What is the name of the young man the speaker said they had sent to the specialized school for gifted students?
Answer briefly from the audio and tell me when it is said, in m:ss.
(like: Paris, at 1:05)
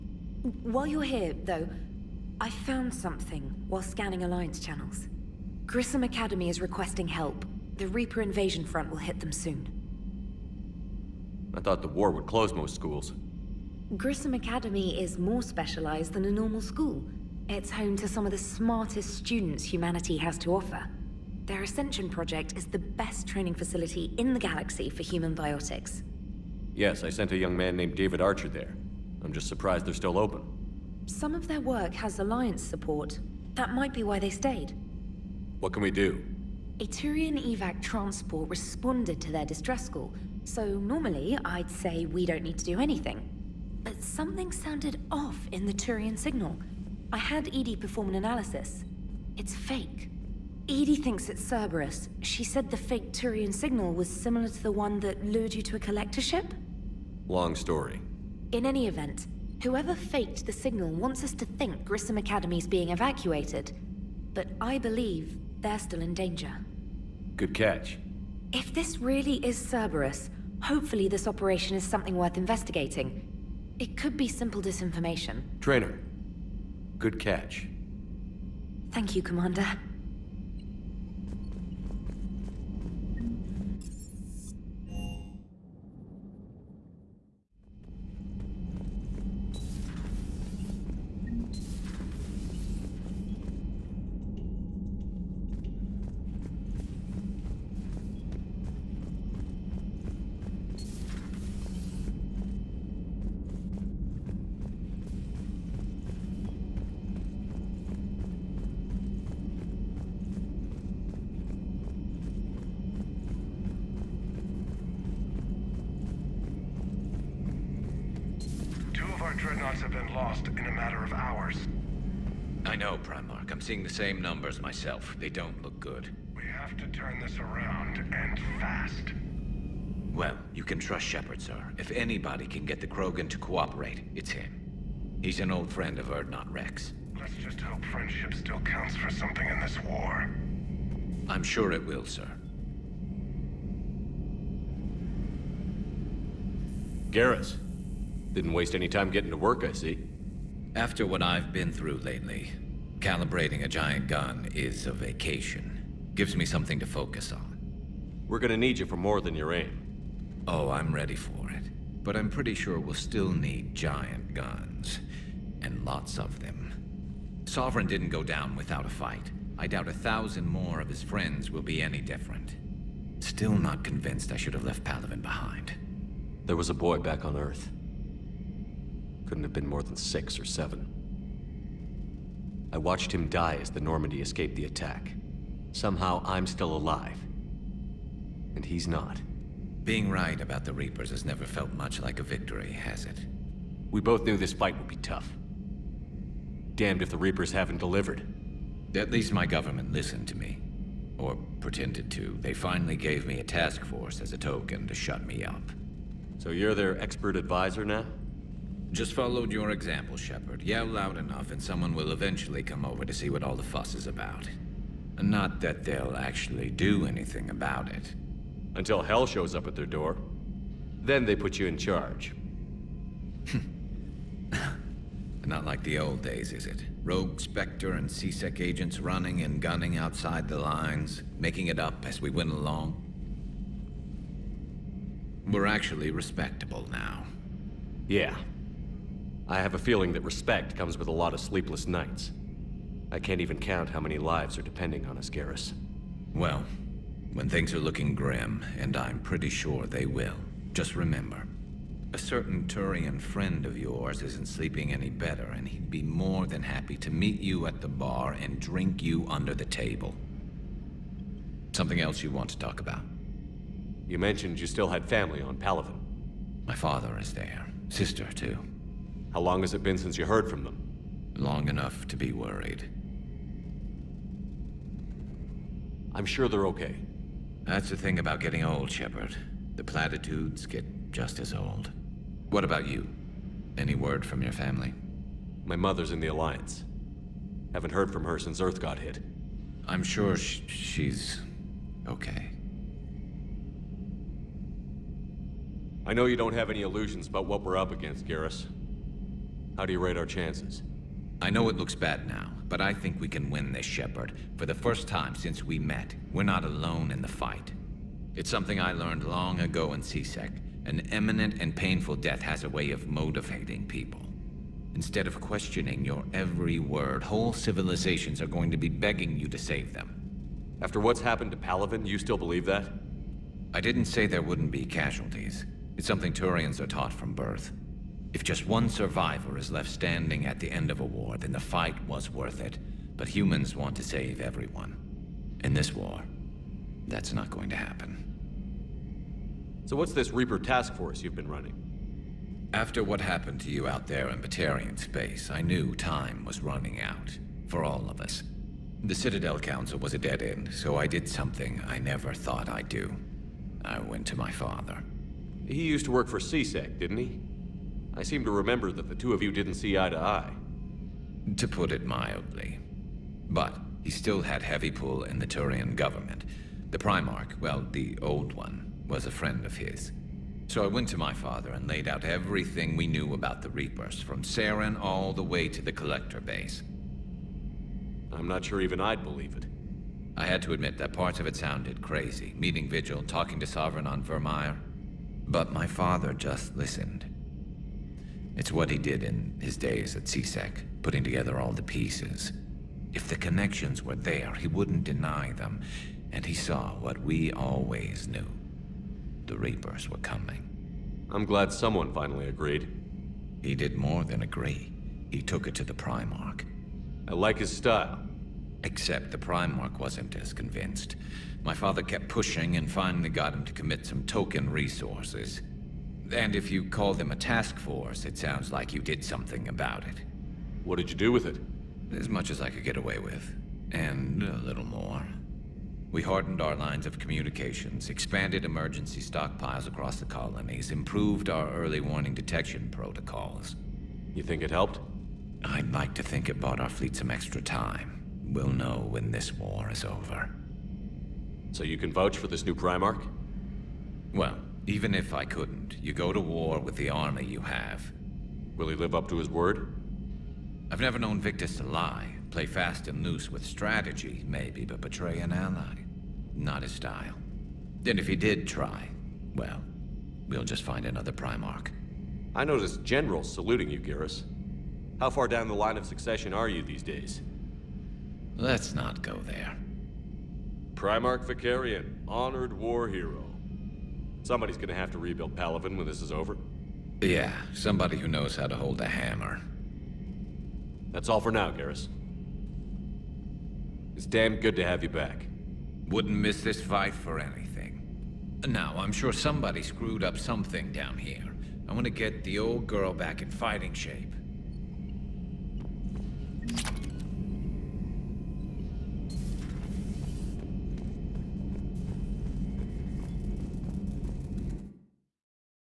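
David Archer, at 0:27.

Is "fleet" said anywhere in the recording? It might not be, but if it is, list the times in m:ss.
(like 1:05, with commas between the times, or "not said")
7:16.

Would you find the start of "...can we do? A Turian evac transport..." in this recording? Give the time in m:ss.
0:35.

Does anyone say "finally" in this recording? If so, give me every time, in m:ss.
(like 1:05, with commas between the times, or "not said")
3:22, 6:42, 6:52.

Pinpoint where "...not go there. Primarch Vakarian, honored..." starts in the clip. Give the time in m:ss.
7:48.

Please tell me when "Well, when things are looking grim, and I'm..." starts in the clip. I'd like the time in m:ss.
4:06.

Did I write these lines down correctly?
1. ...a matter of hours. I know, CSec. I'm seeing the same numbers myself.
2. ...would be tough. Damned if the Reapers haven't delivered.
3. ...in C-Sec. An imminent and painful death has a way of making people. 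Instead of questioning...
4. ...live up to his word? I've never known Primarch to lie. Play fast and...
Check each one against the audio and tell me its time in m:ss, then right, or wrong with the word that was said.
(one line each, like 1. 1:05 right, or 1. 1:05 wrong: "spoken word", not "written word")
1. 2:00 wrong: "Primarch", not "CSec"
2. 3:14 right
3. 5:09 wrong: "motivating", not "making"
4. 7:28 wrong: "Victus", not "Primarch".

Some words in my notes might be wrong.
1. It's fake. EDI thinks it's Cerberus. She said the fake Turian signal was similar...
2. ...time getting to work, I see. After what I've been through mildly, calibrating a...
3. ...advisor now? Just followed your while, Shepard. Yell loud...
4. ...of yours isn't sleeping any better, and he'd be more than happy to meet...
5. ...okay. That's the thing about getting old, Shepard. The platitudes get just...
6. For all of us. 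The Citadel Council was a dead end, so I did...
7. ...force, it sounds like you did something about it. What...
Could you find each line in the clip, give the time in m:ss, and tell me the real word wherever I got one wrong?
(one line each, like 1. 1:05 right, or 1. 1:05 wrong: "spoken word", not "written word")
1. 0:49 right
2. 2:28 wrong: "lately", not "mildly"
3. 3:27 wrong: "example", not "while"
4. 4:13 right
5. 4:36 right
6. 5:47 right
7. 6:57 right.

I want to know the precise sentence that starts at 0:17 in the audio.
It's home to some of the smartest students humanity has to offer.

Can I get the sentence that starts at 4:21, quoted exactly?
Something else you want to talk about?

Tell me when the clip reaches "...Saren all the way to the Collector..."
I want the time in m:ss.
6:14.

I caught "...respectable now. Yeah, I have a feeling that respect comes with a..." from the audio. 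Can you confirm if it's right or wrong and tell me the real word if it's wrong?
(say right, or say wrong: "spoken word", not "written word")
right.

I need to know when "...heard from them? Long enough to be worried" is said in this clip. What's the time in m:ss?
4:30.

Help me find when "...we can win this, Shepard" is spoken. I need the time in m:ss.
5:03.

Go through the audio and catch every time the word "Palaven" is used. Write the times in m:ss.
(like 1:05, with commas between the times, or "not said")
2:54, 4:25, 5:21, 7:55.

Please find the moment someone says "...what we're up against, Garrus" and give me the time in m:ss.
4:57.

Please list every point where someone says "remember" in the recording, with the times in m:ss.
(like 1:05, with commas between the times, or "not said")
4:10, 5:58.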